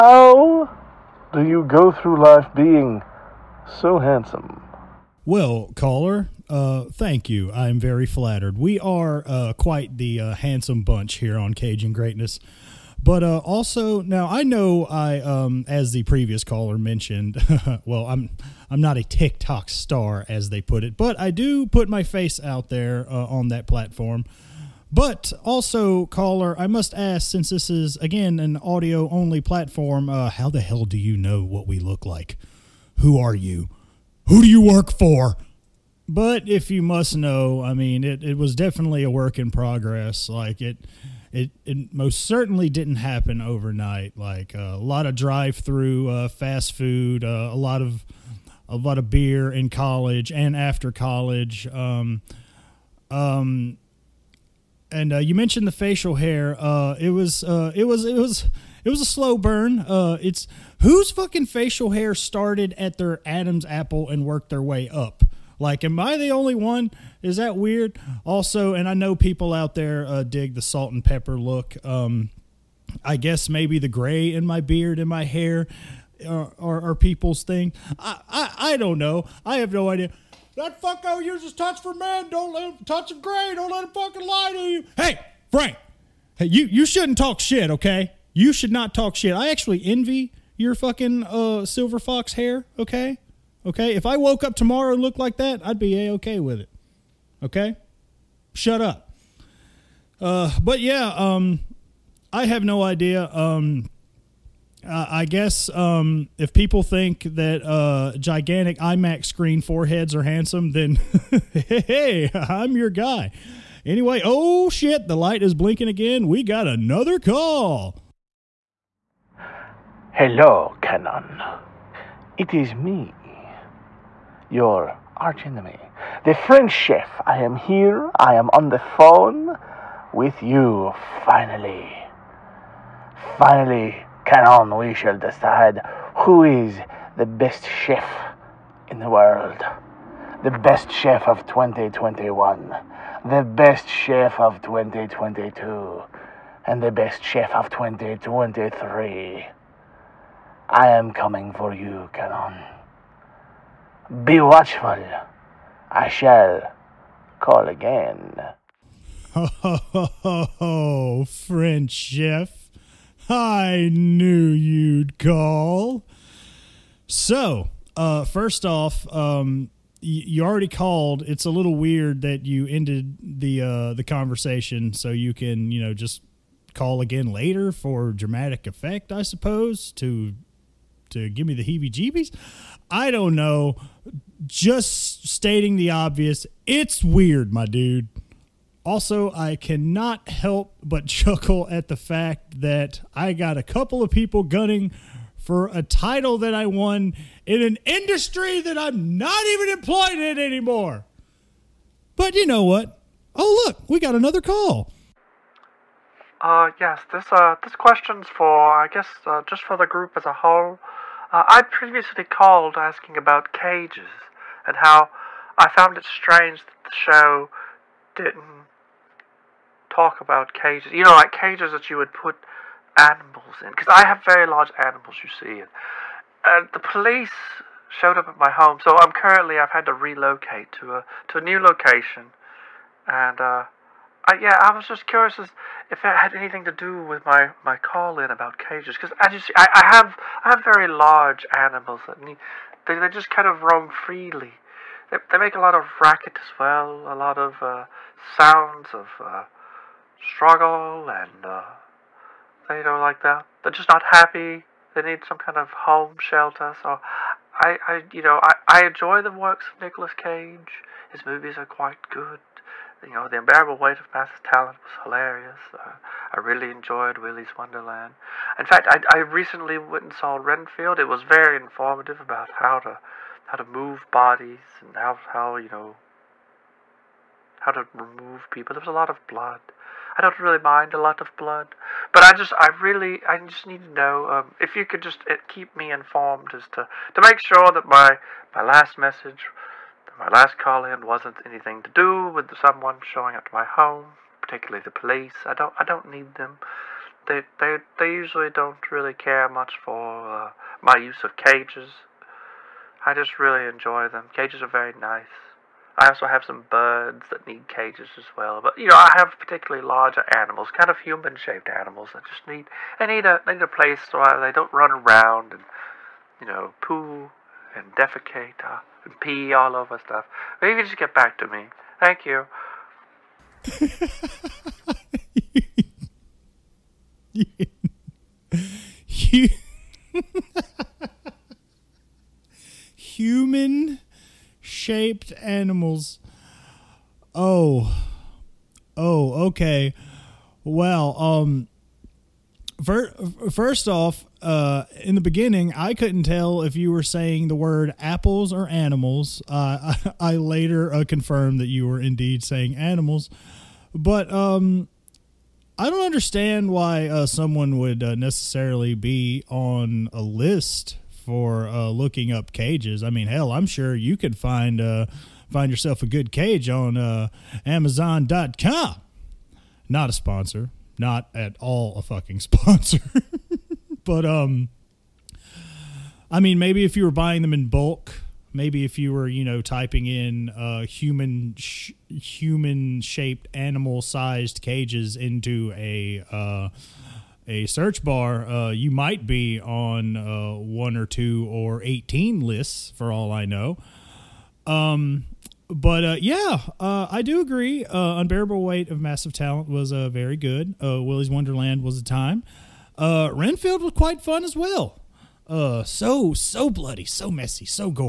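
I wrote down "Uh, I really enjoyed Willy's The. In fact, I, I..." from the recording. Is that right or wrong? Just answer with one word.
wrong.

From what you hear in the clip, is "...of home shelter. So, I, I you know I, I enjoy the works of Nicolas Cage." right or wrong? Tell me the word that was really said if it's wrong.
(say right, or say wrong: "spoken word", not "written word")
right.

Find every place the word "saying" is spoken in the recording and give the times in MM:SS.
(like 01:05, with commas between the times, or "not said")
05:47, 05:52.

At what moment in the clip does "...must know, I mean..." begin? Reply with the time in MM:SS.
00:36.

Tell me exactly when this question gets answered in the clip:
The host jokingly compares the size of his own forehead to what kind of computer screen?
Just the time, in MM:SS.
01:48.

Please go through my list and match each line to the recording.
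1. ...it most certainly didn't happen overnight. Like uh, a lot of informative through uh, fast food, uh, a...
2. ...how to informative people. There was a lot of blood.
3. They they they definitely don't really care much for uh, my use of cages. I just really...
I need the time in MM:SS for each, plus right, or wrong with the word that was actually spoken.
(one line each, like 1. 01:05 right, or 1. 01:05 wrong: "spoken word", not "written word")
1. 00:41 wrong: "drive", not "informative"
2. 04:37 wrong: "remove", not "informative"
3. 04:57 wrong: "usually", not "definitely".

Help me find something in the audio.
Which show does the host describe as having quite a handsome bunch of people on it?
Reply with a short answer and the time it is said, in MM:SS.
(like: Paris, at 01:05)
Caging Greatness, at 00:11.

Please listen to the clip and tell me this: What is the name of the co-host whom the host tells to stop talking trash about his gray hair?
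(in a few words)
Frank.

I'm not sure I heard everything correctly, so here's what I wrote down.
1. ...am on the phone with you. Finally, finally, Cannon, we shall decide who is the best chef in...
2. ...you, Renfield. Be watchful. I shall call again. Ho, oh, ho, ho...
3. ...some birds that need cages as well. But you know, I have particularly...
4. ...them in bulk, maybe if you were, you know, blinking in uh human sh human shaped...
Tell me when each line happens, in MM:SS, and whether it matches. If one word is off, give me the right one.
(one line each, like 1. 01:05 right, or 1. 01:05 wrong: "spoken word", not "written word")
1. 02:08 right
2. 02:31 wrong: "Cannon", not "Renfield"
3. 05:06 right
4. 06:17 wrong: "typing", not "blinking".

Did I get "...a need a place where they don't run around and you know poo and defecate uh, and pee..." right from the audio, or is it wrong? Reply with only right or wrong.
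right.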